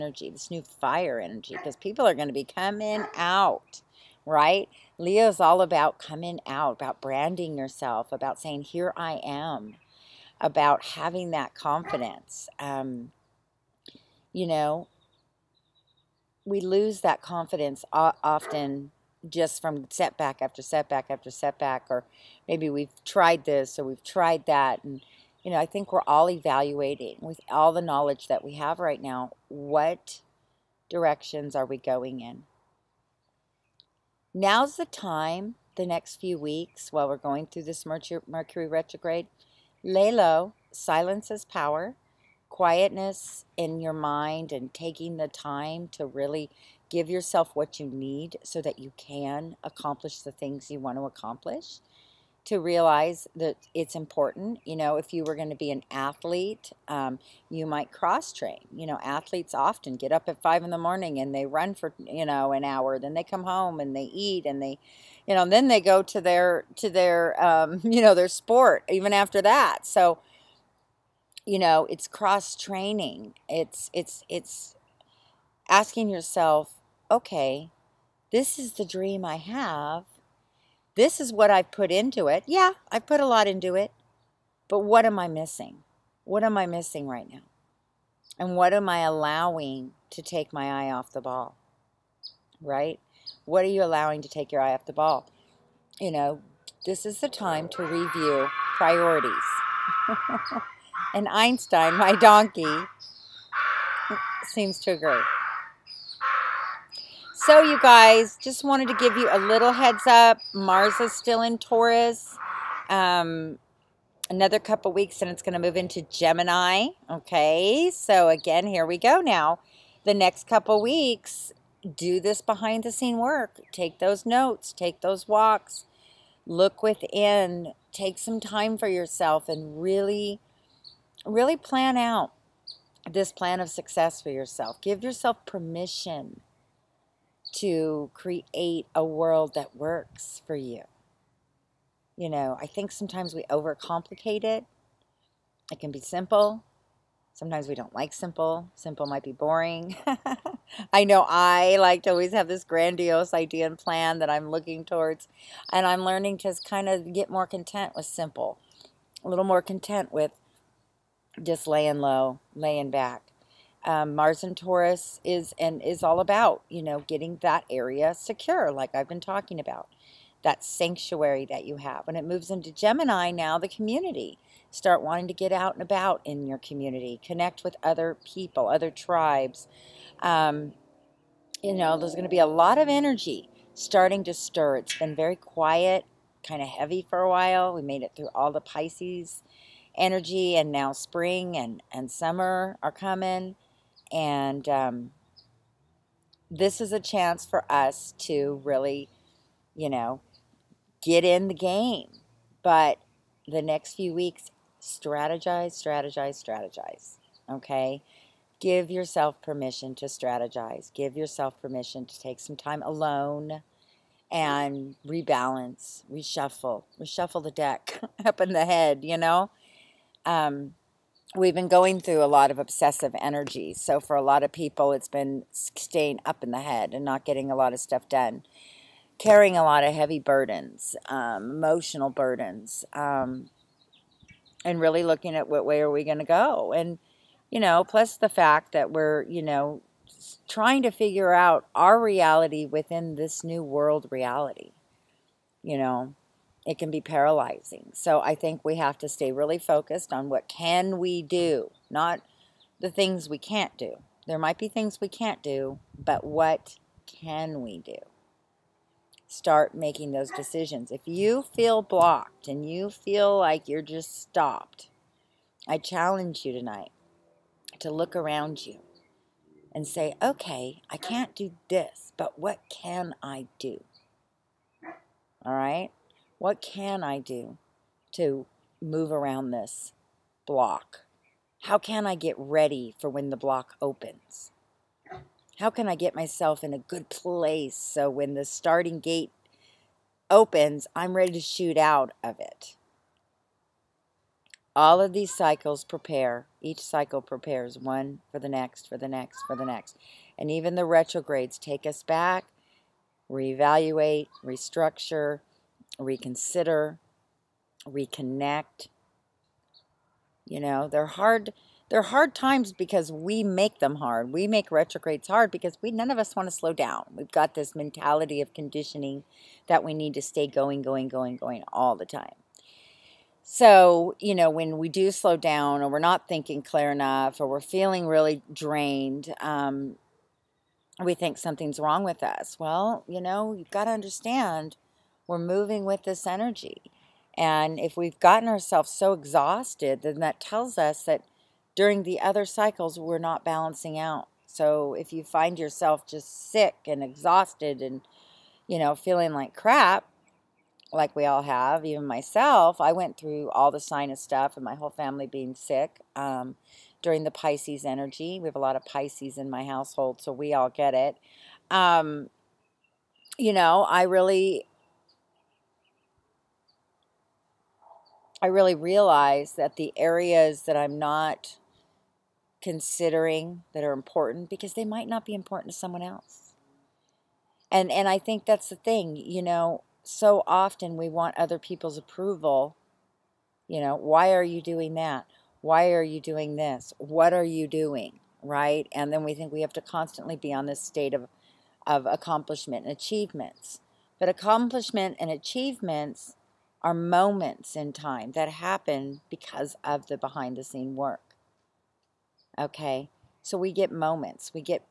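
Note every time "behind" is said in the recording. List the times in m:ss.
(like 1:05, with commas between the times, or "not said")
2:02, 6:40.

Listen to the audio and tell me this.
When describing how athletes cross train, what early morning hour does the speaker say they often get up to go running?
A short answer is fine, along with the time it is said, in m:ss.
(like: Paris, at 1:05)
5 in the morning, at 1:00.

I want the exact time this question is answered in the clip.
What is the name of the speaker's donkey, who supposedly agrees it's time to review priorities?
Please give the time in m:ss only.
1:41.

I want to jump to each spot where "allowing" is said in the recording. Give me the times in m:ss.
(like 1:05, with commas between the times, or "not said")
1:29, 1:33.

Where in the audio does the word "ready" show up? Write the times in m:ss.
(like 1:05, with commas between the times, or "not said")
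4:42, 4:51.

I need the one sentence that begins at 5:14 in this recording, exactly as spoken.
We make retrogrades hard because we none of us want to slow down.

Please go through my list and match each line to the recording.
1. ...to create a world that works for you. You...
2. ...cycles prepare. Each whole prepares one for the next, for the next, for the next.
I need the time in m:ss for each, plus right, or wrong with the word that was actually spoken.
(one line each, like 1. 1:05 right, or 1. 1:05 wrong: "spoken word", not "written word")
1. 2:17 right
2. 4:55 wrong: "cycle", not "whole".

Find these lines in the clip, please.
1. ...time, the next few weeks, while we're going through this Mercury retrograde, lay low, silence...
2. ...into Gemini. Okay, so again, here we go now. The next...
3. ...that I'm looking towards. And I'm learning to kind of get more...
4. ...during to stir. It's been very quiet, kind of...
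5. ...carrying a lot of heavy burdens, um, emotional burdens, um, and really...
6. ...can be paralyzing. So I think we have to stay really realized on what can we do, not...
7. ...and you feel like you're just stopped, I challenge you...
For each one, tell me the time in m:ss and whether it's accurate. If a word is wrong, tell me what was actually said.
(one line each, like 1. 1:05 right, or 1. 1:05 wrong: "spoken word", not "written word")
1. 0:34 right
2. 1:55 right
3. 2:34 right
4. 3:03 wrong: "starting", not "during"
5. 3:49 right
6. 4:06 wrong: "focused", not "realized"
7. 4:22 right.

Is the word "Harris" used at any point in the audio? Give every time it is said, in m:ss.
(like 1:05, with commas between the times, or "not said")
not said.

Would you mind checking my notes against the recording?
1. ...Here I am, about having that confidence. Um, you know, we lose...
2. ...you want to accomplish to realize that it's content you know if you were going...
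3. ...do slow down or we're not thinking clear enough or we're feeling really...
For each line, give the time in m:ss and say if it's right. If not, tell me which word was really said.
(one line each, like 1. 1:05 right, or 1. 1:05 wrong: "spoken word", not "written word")
1. 0:08 right
2. 0:50 wrong: "important", not "content"
3. 5:24 right.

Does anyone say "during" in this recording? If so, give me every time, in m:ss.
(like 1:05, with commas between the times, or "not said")
5:41, 5:57.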